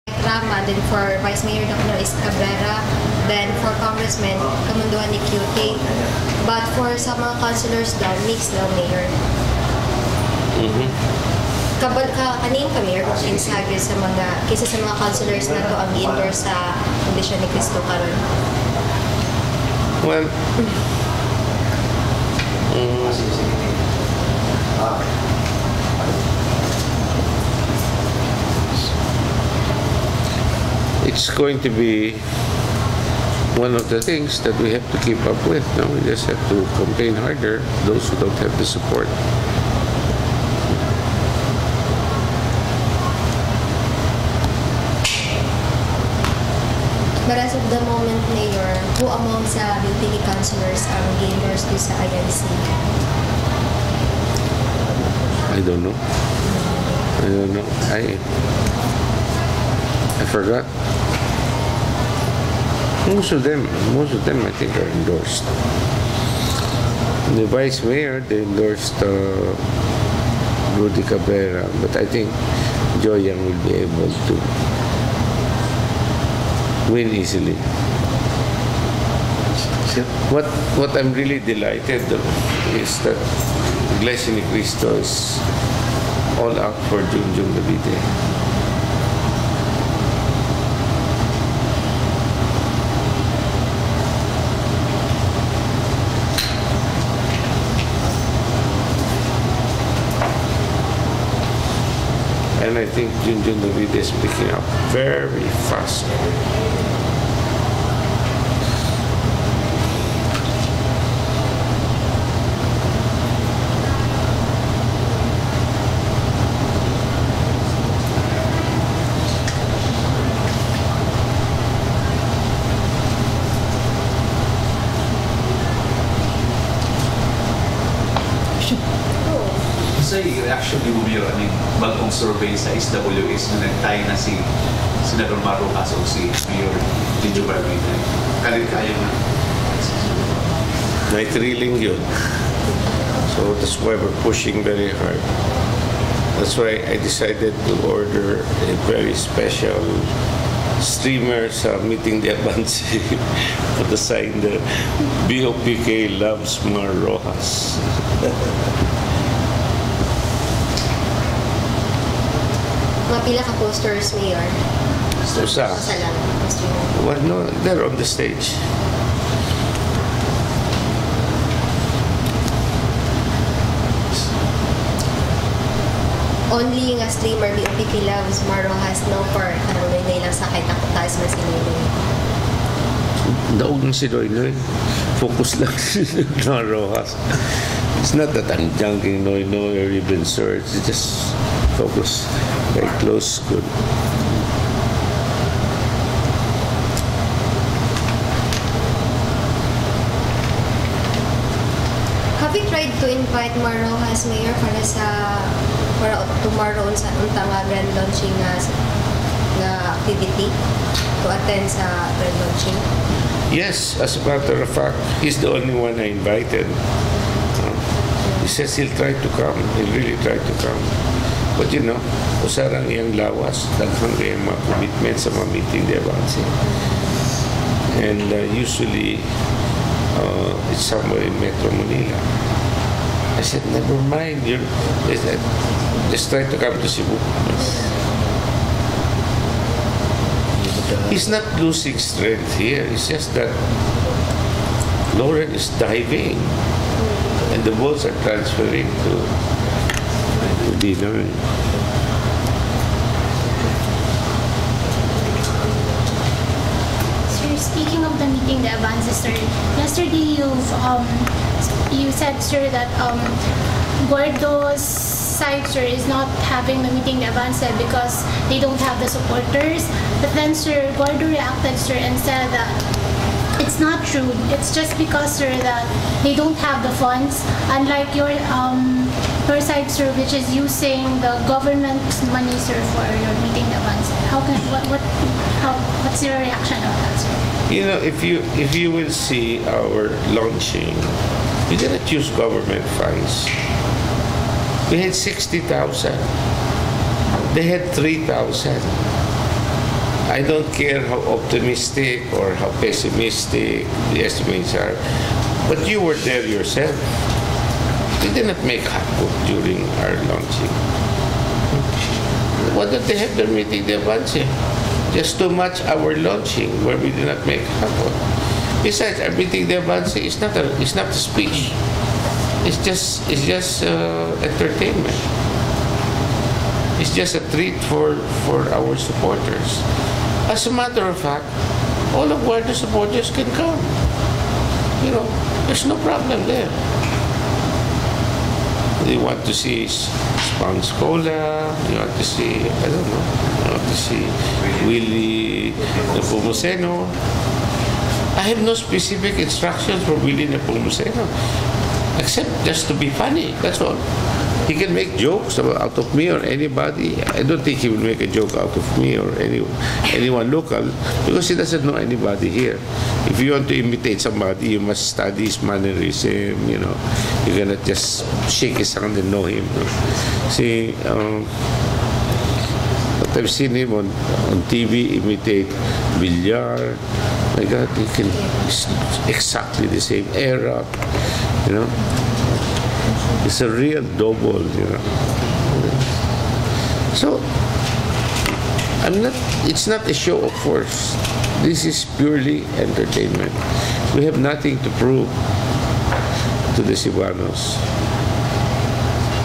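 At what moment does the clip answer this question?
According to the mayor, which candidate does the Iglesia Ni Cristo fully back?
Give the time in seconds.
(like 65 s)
87 s.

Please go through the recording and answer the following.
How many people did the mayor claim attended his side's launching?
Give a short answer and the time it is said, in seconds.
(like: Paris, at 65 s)
60,000, at 295 s.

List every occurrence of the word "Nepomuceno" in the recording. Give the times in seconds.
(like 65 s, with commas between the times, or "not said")
346 s, 350 s.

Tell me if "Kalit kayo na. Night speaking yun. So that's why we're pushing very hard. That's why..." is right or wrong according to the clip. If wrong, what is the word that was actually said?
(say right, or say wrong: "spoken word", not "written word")
wrong: "thrilling", not "speaking".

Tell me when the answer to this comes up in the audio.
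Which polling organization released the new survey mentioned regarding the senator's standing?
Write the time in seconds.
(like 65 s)
132 s.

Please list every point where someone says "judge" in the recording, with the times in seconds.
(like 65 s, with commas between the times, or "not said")
not said.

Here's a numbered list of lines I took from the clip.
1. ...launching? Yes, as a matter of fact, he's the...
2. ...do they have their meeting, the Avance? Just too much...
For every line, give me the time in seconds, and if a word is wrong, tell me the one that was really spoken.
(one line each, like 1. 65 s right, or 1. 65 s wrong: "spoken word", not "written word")
1. 212 s right
2. 312 s right.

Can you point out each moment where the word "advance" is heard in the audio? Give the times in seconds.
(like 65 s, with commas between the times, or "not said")
152 s, 258 s, 267 s.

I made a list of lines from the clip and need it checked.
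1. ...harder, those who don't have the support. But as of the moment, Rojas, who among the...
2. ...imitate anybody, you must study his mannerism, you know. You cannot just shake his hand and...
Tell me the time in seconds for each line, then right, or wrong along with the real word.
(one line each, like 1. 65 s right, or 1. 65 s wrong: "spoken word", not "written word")
1. 37 s wrong: "Mayor", not "Rojas"
2. 363 s wrong: "somebody", not "anybody".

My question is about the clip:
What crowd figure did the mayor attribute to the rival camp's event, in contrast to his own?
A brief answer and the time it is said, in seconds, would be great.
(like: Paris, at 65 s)
3,000, at 297 s.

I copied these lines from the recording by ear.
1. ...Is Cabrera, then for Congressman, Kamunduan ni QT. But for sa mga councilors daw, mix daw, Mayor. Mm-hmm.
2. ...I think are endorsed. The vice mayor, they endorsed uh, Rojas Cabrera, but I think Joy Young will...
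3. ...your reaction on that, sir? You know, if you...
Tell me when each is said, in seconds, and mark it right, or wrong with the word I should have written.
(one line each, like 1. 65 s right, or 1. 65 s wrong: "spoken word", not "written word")
1. 1 s right
2. 64 s wrong: "Rudy", not "Rojas"
3. 286 s right.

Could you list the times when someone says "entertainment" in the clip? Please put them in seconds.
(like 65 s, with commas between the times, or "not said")
324 s, 392 s.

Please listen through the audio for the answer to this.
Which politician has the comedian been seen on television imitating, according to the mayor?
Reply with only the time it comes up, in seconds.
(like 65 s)
376 s.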